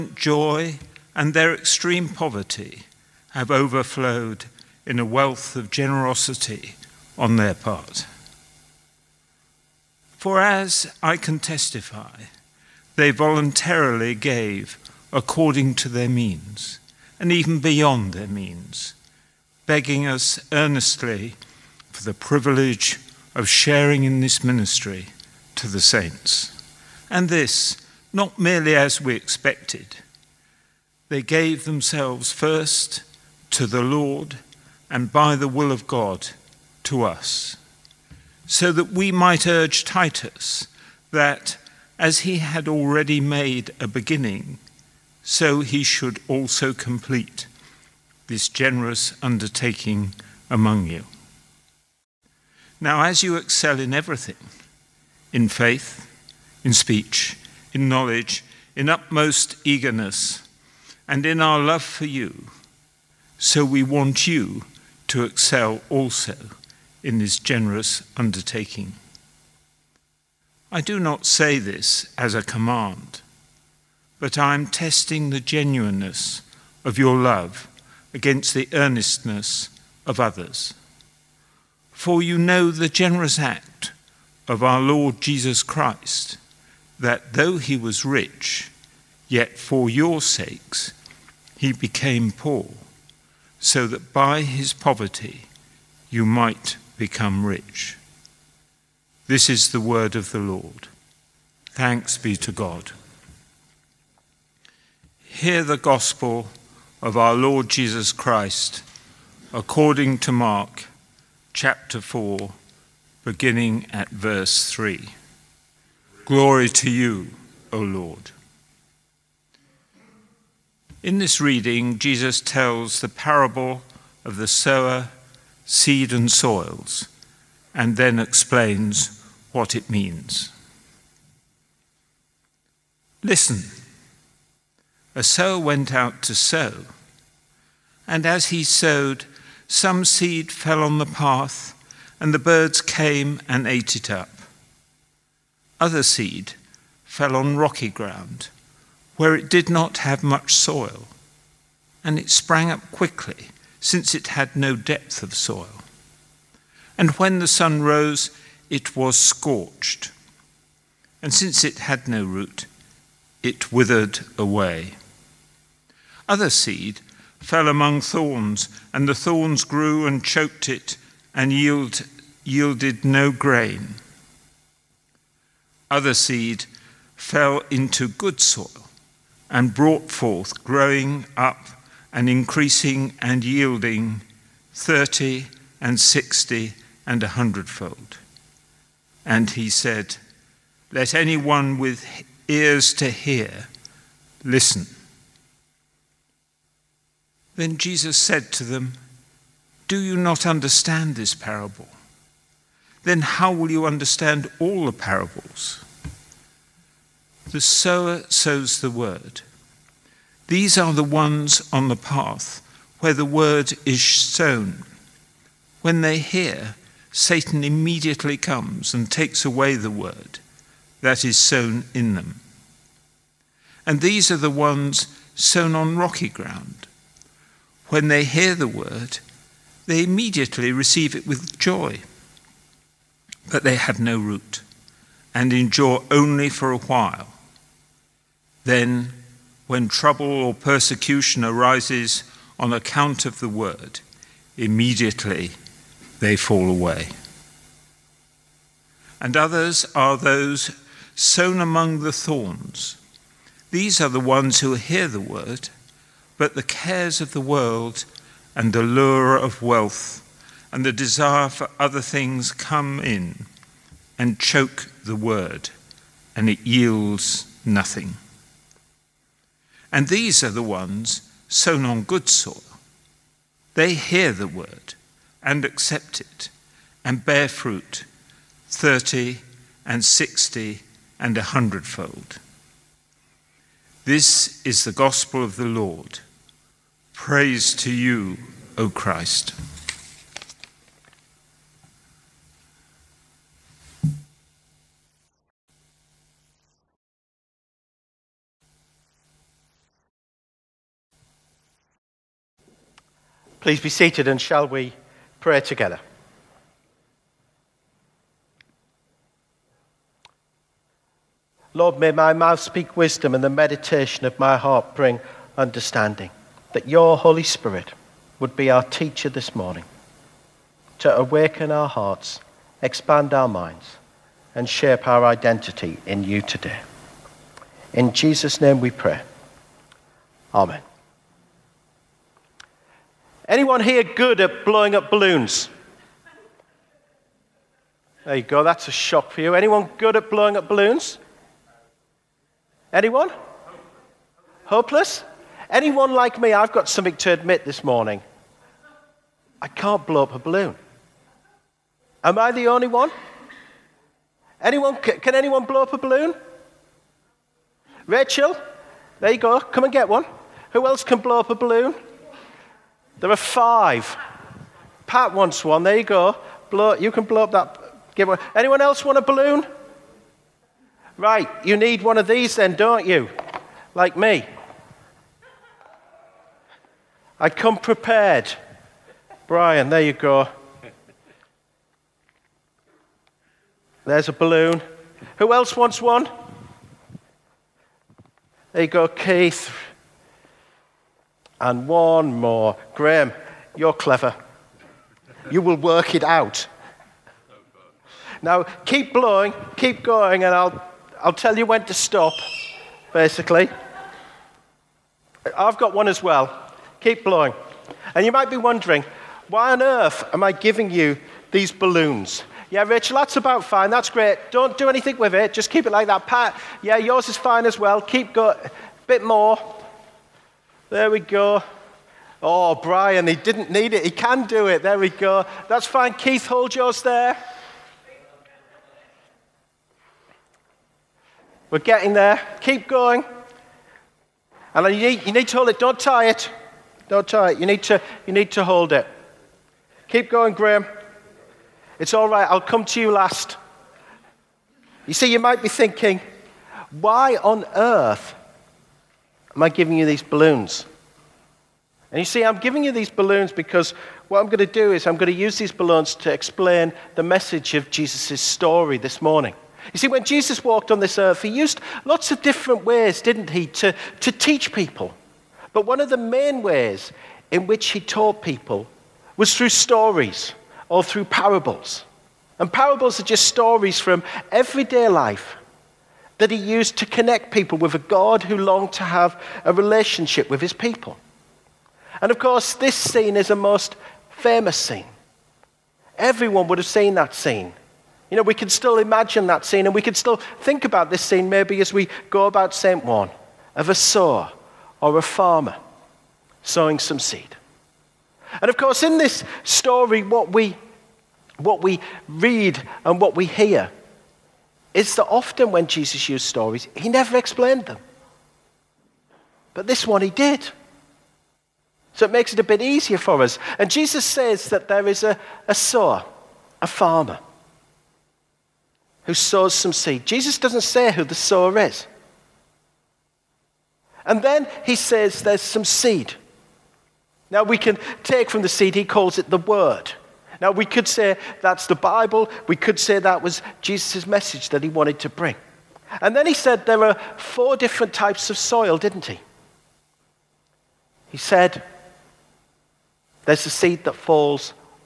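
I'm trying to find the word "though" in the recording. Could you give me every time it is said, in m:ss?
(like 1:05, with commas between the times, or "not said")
1:27.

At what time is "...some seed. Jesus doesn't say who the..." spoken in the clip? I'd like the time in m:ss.
8:39.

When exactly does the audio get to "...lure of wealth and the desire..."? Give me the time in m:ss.
4:18.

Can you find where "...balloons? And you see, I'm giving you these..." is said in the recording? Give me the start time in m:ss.
7:30.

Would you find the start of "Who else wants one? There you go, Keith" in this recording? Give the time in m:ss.
6:25.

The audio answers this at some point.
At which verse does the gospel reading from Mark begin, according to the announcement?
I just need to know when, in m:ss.
1:54.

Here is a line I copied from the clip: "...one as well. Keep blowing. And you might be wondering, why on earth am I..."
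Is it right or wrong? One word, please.
right.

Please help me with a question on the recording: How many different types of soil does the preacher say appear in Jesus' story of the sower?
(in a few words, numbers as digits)
4.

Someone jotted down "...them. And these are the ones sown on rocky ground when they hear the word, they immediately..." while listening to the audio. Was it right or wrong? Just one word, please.
right.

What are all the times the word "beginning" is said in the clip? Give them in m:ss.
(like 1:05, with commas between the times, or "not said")
0:43, 1:53.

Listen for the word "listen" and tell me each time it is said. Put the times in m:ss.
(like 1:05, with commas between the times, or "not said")
2:13, 3:14.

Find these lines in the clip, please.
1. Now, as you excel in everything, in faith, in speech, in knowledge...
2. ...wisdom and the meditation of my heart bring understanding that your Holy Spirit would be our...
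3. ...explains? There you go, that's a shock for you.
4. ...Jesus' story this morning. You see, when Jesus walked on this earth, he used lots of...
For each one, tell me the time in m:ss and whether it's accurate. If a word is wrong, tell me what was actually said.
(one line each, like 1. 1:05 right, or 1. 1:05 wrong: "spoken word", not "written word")
1. 0:52 right
2. 5:12 right
3. 5:35 wrong: "balloons", not "explains"
4. 7:37 right.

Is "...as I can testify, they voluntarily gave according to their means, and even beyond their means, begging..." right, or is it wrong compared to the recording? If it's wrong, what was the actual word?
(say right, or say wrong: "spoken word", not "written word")
right.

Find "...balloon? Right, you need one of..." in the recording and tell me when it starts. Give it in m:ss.
6:09.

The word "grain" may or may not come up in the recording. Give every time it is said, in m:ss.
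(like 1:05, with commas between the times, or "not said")
2:53.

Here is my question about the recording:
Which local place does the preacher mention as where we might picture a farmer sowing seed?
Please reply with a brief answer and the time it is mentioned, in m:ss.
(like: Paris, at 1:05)
St. Ouen, at 8:12.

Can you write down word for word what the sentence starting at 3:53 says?
But they have no root and endure only for a while.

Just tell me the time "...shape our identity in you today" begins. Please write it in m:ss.
5:24.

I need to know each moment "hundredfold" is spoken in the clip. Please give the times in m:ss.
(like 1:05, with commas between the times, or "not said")
3:07, 4:41.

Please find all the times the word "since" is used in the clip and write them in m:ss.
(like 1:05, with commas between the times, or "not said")
2:33, 2:41.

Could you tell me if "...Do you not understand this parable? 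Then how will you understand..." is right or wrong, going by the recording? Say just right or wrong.
right.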